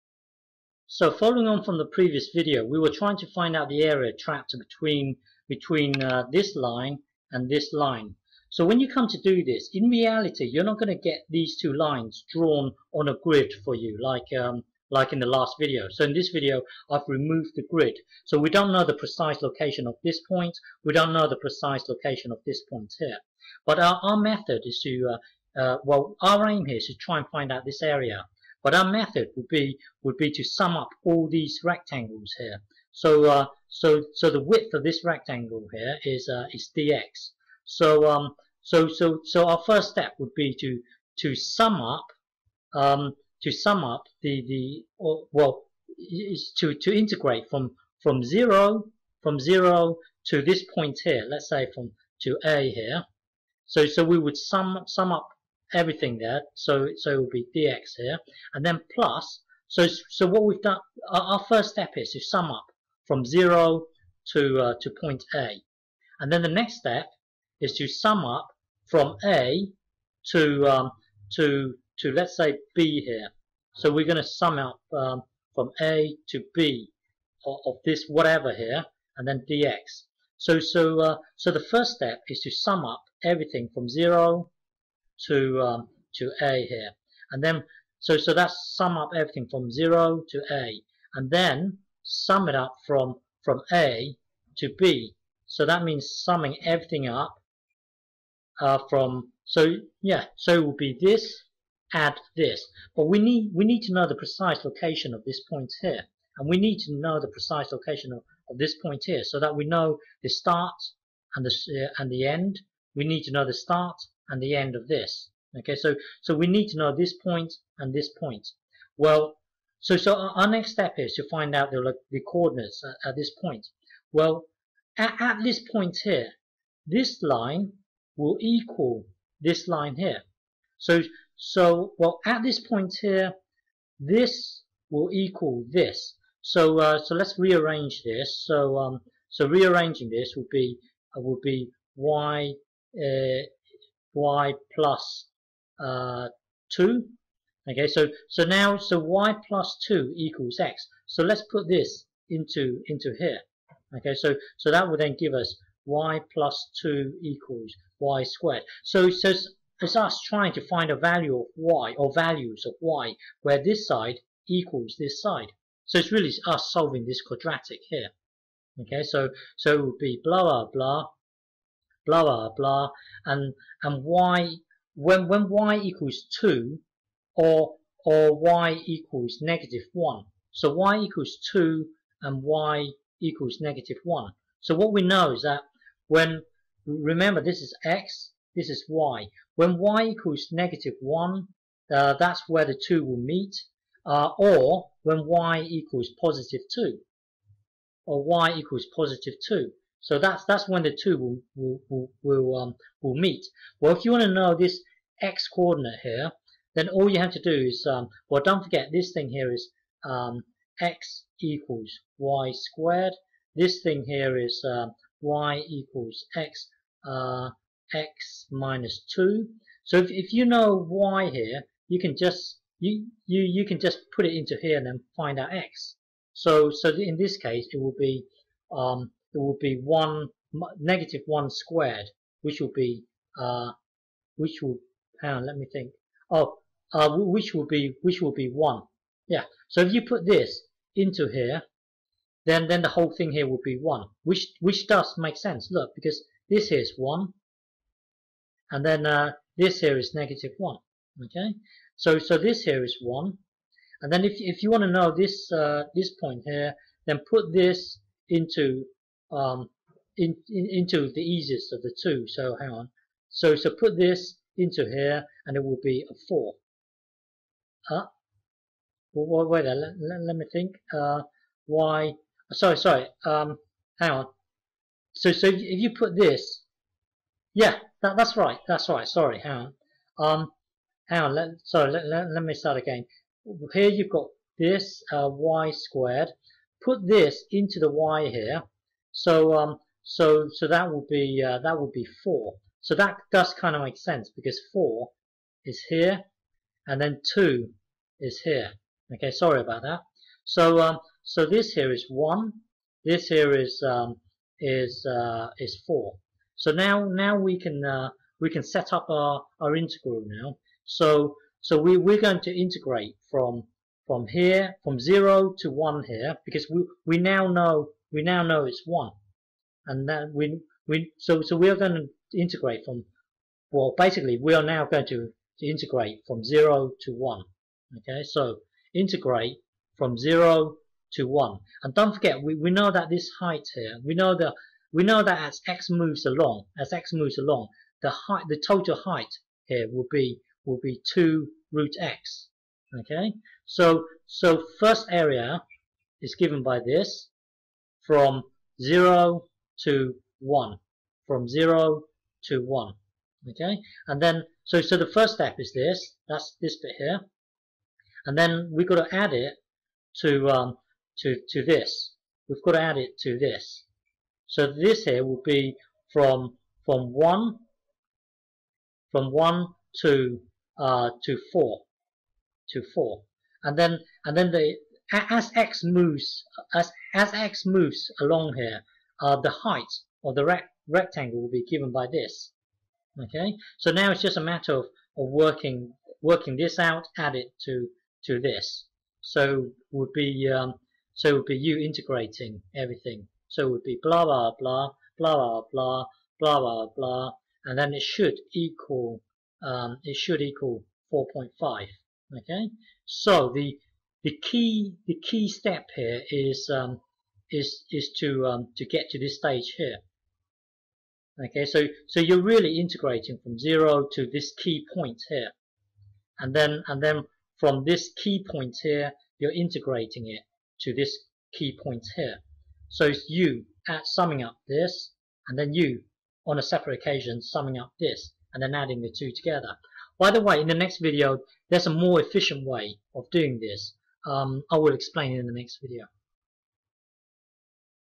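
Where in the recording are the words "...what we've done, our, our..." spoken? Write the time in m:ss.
1:00.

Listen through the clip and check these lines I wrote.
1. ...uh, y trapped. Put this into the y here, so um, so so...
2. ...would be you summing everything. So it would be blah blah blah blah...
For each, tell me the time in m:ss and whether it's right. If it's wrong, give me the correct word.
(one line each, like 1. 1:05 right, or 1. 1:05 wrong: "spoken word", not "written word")
1. 4:45 wrong: "squared", not "trapped"
2. 6:31 wrong: "integrating", not "summing".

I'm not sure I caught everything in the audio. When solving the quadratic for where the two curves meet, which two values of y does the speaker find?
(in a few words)
2 and -1.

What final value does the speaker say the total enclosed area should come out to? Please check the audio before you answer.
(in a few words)
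4.5.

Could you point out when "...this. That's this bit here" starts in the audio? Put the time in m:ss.
5:55.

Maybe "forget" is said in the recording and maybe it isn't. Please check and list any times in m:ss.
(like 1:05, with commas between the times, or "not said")
3:28, 5:32.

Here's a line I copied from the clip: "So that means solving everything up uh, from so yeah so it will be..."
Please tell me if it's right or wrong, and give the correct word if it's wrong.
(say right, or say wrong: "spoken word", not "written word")
wrong: "summing", not "solving".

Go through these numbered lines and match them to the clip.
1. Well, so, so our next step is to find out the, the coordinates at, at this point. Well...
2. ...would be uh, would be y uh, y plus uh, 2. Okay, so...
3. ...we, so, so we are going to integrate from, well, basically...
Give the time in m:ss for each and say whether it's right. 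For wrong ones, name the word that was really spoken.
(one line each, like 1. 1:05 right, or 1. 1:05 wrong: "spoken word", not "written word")
1. 1:58 right
2. 2:20 right
3. 5:20 right.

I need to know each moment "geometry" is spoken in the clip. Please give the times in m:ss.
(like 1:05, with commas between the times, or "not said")
not said.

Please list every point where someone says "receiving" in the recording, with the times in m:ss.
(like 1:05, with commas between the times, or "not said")
not said.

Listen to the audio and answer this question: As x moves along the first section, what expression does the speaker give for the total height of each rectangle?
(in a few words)
2 root x.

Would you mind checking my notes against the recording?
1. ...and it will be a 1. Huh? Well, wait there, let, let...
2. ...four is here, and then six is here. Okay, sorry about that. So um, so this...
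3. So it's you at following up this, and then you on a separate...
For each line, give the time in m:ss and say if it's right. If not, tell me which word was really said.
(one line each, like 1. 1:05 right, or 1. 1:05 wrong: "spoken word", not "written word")
1. 4:25 wrong: "4", not "1"
2. 4:54 wrong: "two", not "six"
3. 7:02 wrong: "summing", not "following".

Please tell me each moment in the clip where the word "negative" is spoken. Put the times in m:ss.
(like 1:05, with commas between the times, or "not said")
2:59, 3:03, 3:10, 3:50, 4:10.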